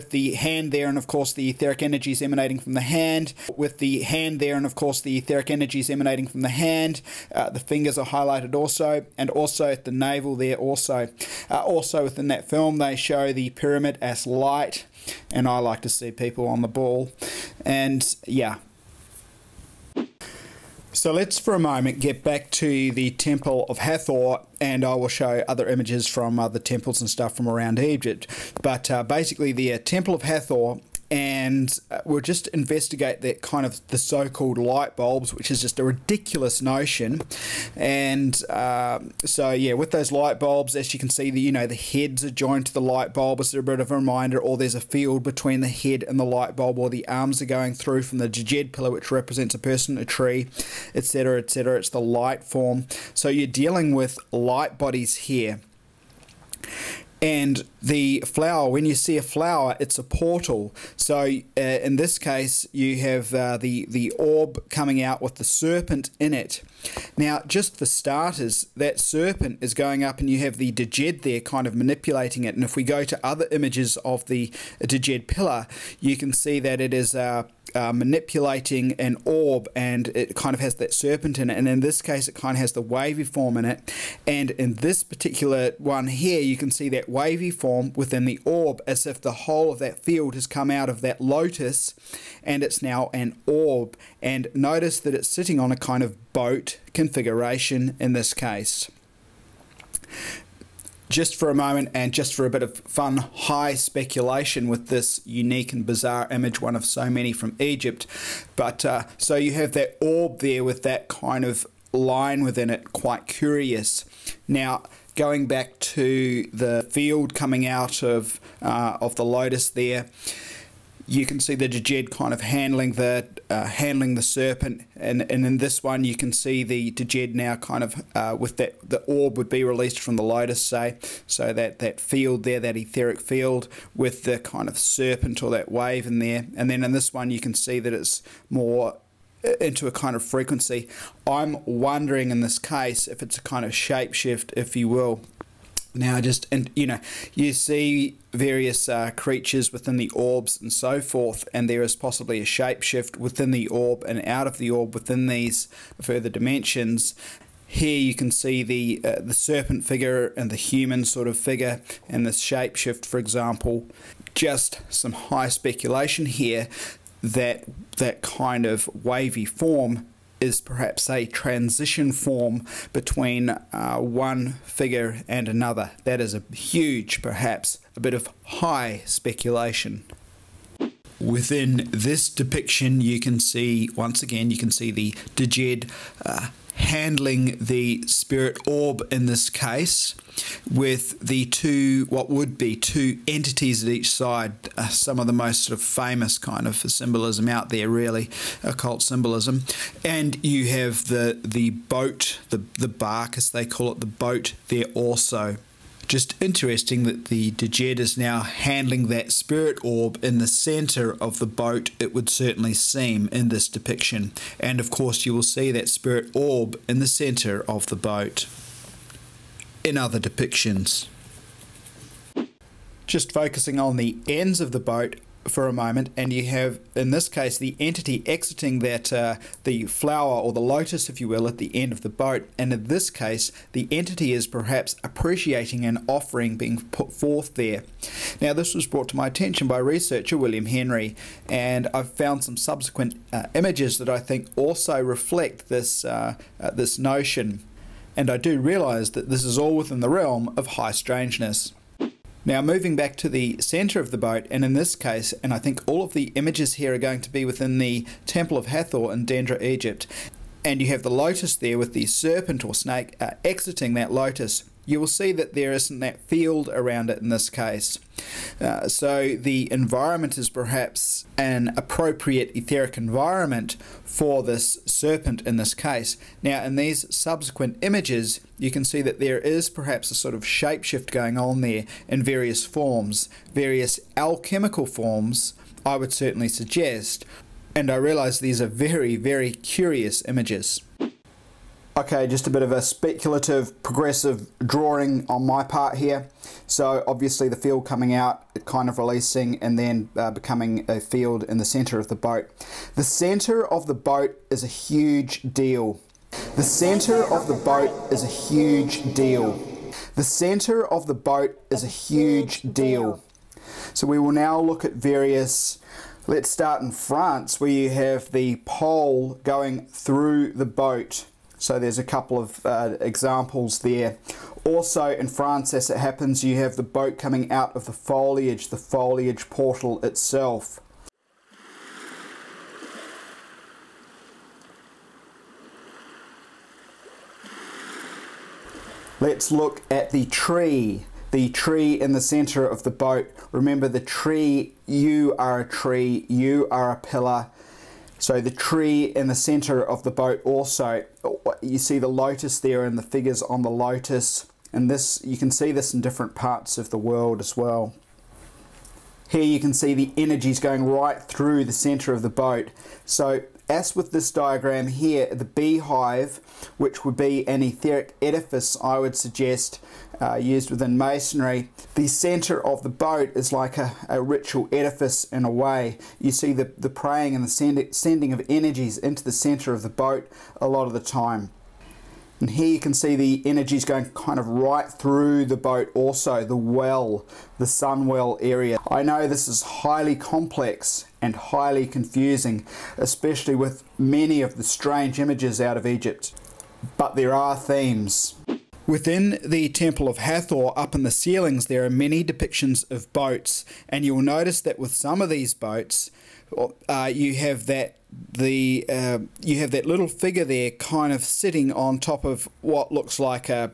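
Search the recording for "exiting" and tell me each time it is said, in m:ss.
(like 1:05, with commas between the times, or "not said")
3:48, 4:23.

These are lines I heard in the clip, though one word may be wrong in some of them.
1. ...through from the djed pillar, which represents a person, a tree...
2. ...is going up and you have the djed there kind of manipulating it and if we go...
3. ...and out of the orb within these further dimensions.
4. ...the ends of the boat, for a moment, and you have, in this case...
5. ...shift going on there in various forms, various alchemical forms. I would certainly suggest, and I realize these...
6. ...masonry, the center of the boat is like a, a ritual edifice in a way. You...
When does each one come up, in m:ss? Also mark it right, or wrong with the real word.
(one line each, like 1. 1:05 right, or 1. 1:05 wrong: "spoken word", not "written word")
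1. 0:47 right
2. 1:09 right
3. 2:34 right
4. 3:43 right
5. 4:40 right
6. 6:10 right.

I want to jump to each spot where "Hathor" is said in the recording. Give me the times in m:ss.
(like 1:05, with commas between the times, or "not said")
0:23, 0:30, 4:18, 6:40.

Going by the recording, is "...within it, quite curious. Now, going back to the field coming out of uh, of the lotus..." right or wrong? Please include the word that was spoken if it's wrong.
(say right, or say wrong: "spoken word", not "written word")
right.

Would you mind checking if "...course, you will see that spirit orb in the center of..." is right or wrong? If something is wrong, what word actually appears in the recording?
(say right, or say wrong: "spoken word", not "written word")
right.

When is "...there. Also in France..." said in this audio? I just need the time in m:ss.
5:23.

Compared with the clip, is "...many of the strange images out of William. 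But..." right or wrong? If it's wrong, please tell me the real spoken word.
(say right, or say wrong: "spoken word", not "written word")
wrong: "Egypt", not "William".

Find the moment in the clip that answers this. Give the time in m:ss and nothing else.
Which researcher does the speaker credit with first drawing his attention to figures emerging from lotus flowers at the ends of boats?
4:00.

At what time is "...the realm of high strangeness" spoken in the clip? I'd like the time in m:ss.
4:09.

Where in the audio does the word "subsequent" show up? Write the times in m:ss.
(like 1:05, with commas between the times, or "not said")
4:02, 4:37.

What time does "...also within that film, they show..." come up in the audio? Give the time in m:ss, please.
0:11.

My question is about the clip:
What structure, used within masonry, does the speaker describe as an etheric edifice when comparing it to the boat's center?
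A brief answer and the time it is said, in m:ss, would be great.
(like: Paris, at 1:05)
Beehive, at 6:05.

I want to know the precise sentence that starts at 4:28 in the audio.
Uh, so the environment is perhaps an appropriate etheric environment for this serpent in this case.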